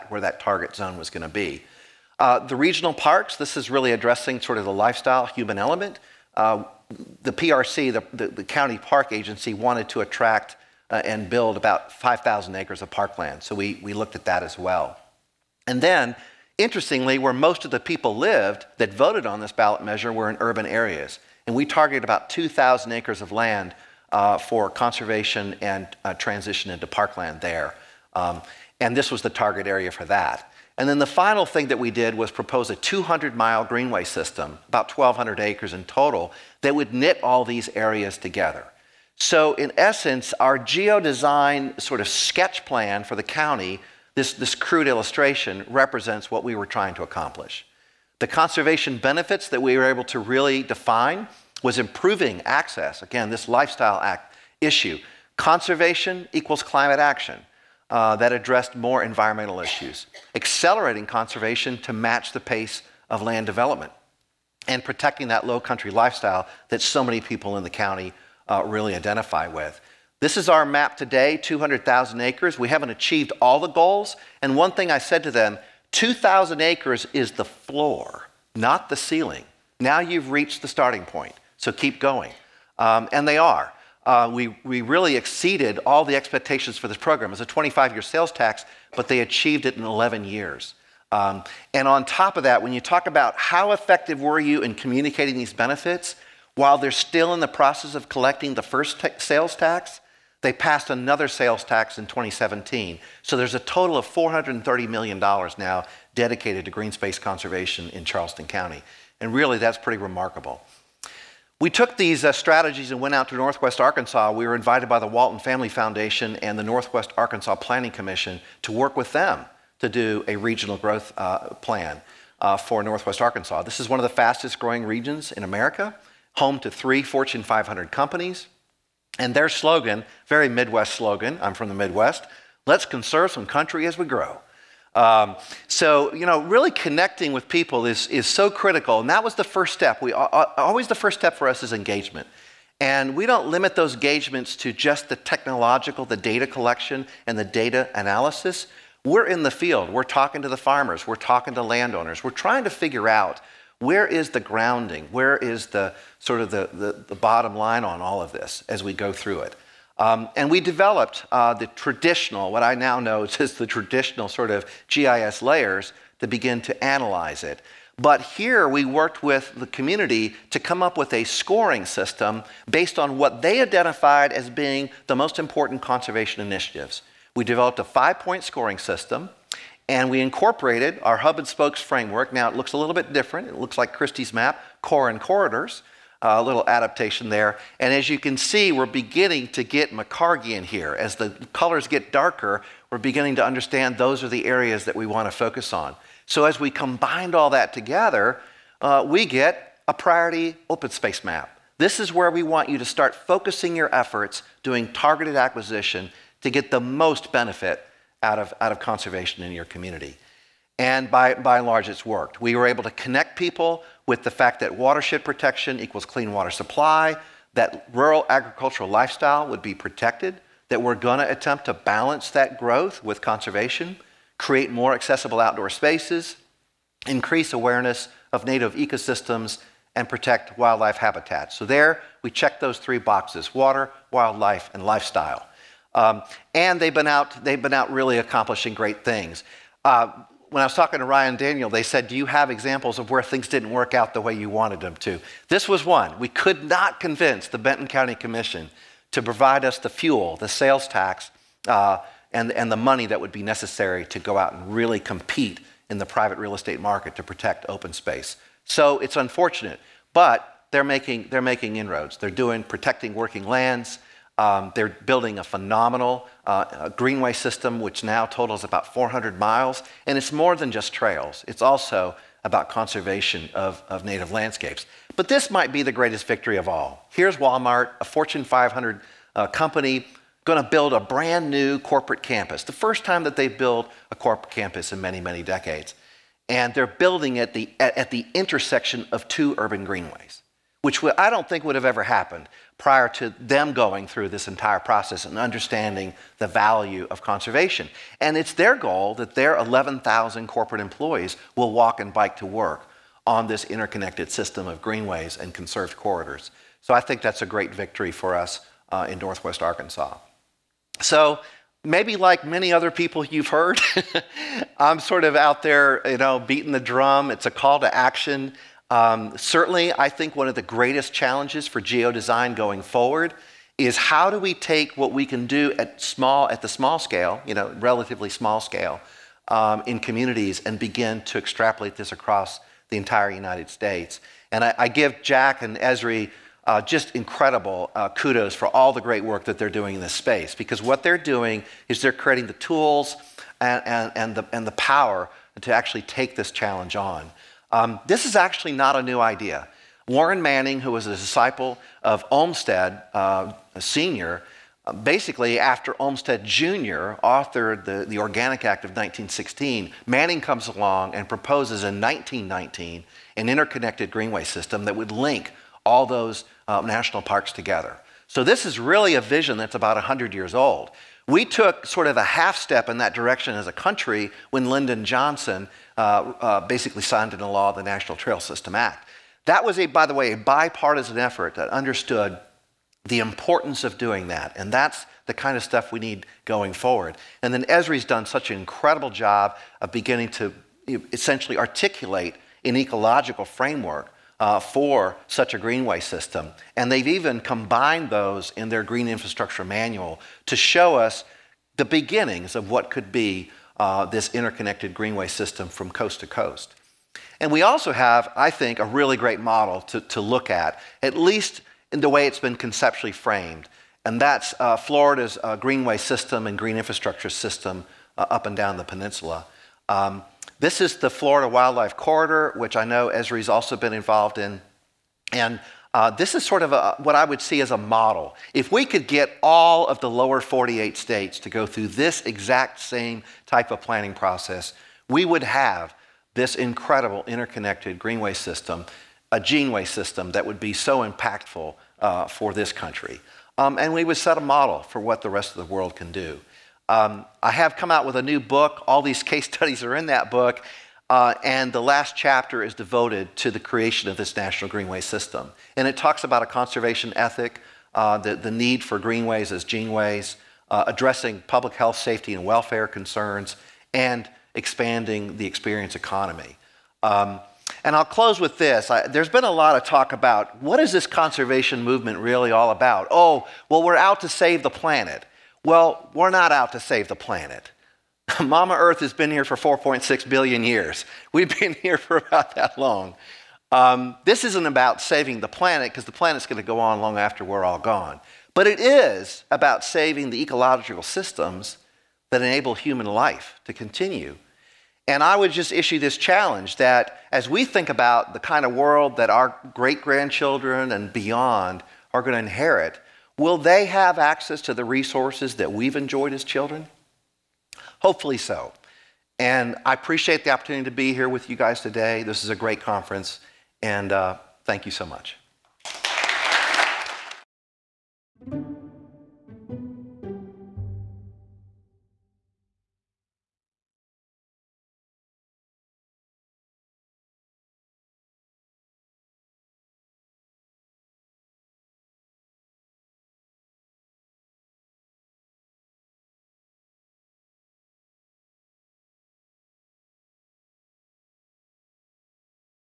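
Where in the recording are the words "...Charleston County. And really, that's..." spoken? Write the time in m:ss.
1:48.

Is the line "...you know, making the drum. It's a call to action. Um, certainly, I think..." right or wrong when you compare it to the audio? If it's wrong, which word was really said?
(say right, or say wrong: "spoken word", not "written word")
wrong: "beating", not "making".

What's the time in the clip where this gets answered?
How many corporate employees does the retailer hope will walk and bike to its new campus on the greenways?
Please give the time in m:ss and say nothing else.
4:59.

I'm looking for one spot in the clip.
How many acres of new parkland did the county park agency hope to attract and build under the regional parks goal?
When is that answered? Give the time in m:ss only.
0:11.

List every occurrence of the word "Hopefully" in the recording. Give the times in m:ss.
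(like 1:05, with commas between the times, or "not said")
8:28.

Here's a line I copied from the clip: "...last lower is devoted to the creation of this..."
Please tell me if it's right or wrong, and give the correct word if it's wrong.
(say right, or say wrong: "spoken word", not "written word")
wrong: "chapter", not "lower".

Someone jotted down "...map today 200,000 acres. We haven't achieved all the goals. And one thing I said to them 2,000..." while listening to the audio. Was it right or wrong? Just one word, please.
right.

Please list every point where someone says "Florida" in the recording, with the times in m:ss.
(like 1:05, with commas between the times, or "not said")
6:54, 7:01.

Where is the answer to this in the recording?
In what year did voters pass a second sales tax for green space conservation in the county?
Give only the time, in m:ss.
1:42.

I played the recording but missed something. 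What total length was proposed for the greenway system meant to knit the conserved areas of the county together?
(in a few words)
200 miles.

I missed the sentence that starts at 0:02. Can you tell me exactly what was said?
Uh, the regional parks, this is really addressing sort of the lifestyle human element.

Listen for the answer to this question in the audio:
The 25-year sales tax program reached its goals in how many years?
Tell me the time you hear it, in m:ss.
1:29.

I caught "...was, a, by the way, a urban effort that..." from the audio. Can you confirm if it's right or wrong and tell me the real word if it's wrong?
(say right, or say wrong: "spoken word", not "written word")
wrong: "bipartisan", not "urban".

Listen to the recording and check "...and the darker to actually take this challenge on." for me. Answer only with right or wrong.
wrong.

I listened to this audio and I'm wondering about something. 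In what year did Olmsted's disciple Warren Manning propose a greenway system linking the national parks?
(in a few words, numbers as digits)
1919.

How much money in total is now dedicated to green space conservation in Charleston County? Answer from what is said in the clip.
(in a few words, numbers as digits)
$430 million.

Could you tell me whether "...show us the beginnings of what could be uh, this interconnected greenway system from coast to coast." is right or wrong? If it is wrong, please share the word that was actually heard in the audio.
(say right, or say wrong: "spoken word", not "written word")
right.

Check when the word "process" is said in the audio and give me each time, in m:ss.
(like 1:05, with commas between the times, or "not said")
1:37, 4:54, 7:14.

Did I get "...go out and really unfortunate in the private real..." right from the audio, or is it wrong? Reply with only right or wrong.
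wrong.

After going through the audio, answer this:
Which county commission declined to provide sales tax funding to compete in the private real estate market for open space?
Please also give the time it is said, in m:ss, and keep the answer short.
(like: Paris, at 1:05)
Benton County Commission, at 4:07.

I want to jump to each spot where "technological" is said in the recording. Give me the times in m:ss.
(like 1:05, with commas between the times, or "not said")
2:25.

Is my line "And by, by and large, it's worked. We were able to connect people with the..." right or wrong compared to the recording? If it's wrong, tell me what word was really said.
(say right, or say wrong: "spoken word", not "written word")
right.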